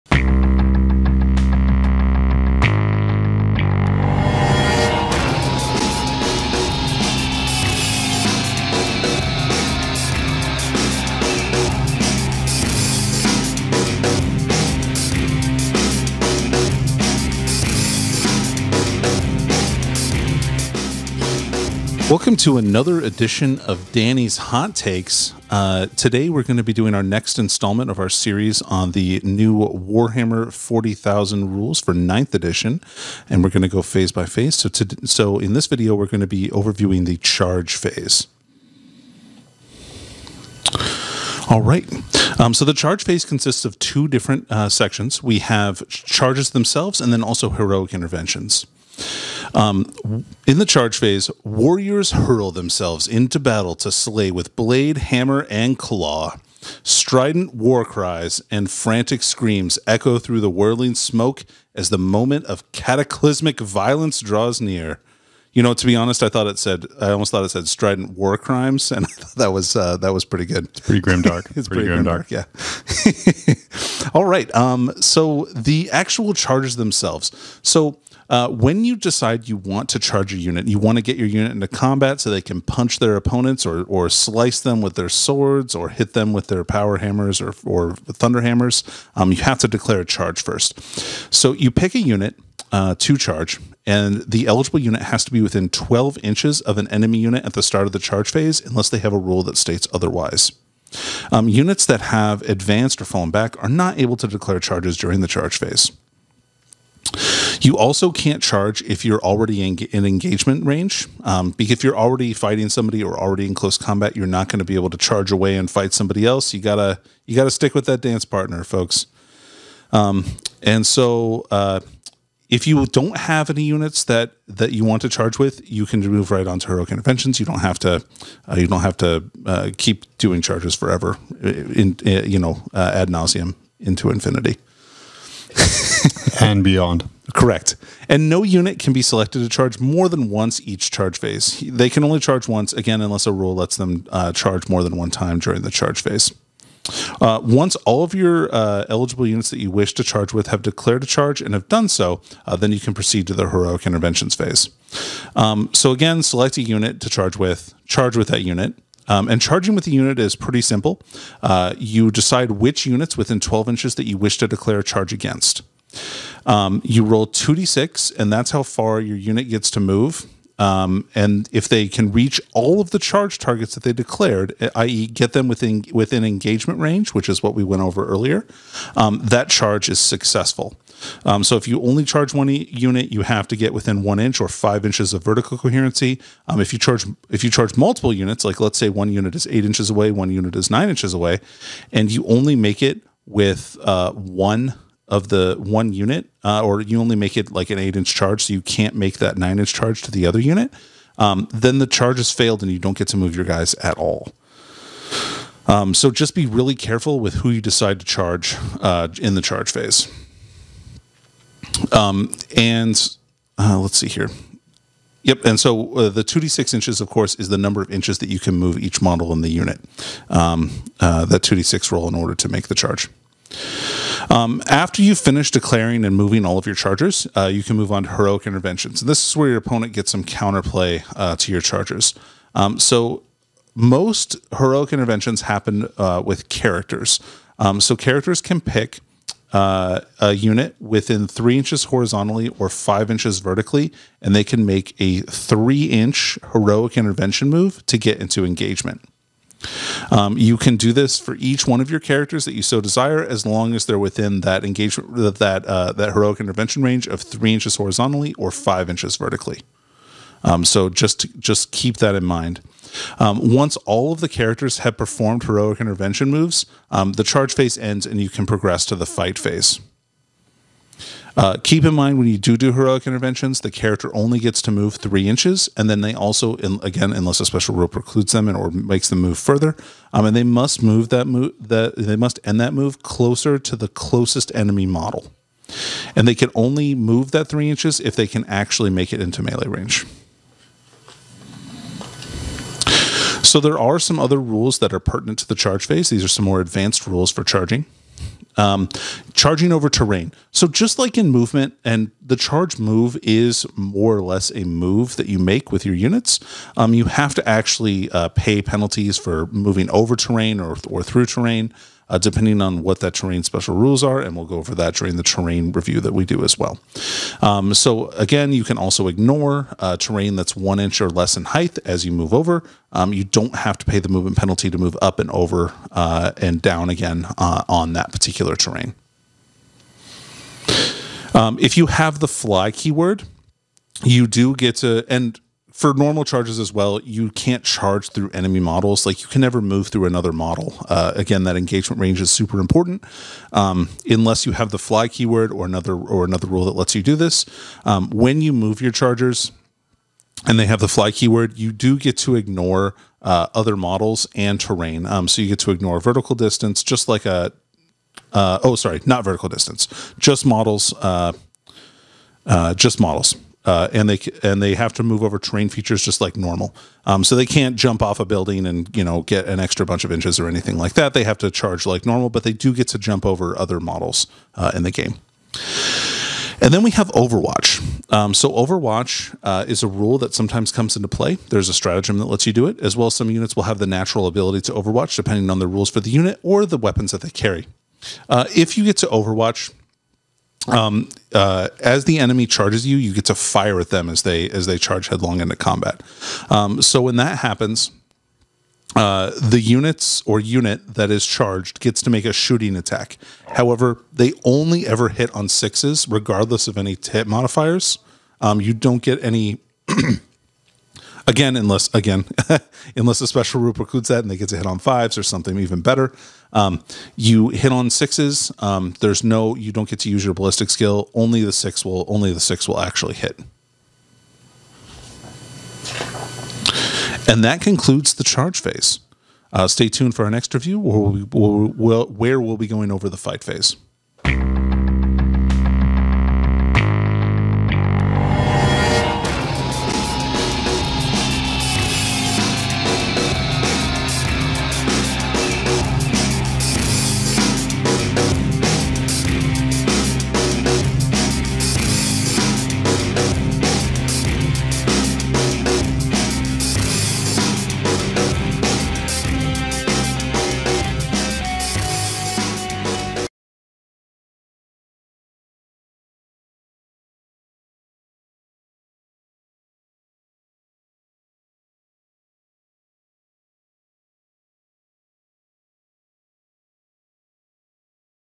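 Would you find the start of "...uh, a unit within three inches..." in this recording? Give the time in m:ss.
3:59.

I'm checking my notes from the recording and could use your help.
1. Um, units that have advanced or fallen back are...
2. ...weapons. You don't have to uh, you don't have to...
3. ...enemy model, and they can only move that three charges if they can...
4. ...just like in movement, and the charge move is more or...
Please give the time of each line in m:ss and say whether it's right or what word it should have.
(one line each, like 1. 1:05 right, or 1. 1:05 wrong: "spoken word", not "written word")
1. 1:41 right
2. 2:06 wrong: "interventions", not "weapons"
3. 4:44 wrong: "inches", not "charges"
4. 5:00 right.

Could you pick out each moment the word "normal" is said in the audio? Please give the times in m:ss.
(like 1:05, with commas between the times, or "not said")
5:35, 6:06, 6:12.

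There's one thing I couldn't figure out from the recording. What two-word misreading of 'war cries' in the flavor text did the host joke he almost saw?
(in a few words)
strident war crimes.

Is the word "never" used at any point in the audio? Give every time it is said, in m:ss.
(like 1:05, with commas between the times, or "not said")
5:39.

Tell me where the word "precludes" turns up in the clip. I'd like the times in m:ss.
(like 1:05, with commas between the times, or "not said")
4:37, 6:53.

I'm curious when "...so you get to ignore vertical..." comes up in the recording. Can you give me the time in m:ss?
5:55.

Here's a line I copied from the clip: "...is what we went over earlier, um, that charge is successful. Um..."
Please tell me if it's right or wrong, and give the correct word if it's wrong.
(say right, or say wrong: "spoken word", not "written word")
right.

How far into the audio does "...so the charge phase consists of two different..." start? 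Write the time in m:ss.
0:42.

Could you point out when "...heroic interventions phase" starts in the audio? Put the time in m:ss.
2:33.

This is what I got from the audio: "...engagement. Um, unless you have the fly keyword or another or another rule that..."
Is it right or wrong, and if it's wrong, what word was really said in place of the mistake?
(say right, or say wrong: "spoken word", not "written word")
wrong: "important", not "engagement".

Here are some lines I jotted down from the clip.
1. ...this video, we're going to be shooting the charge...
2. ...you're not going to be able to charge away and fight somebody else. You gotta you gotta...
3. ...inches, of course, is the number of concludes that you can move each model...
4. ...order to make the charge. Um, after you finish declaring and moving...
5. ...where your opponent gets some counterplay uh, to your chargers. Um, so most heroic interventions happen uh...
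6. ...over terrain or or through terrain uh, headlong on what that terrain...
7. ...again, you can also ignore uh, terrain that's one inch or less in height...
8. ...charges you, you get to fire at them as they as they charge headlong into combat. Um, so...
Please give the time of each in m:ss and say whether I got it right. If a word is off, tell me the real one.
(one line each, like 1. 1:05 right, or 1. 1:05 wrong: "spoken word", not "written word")
1. 0:35 wrong: "overviewing", not "shooting"
2. 1:54 right
3. 3:36 wrong: "inches", not "concludes"
4. 3:42 right
5. 3:49 right
6. 5:09 wrong: "depending", not "headlong"
7. 5:18 right
8. 6:32 right.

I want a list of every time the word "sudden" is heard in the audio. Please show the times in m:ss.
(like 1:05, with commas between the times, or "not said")
not said.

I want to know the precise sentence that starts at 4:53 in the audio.
So there are some other rules that are pertinent to the charge phase.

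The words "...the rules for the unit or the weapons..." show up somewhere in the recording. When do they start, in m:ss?
6:25.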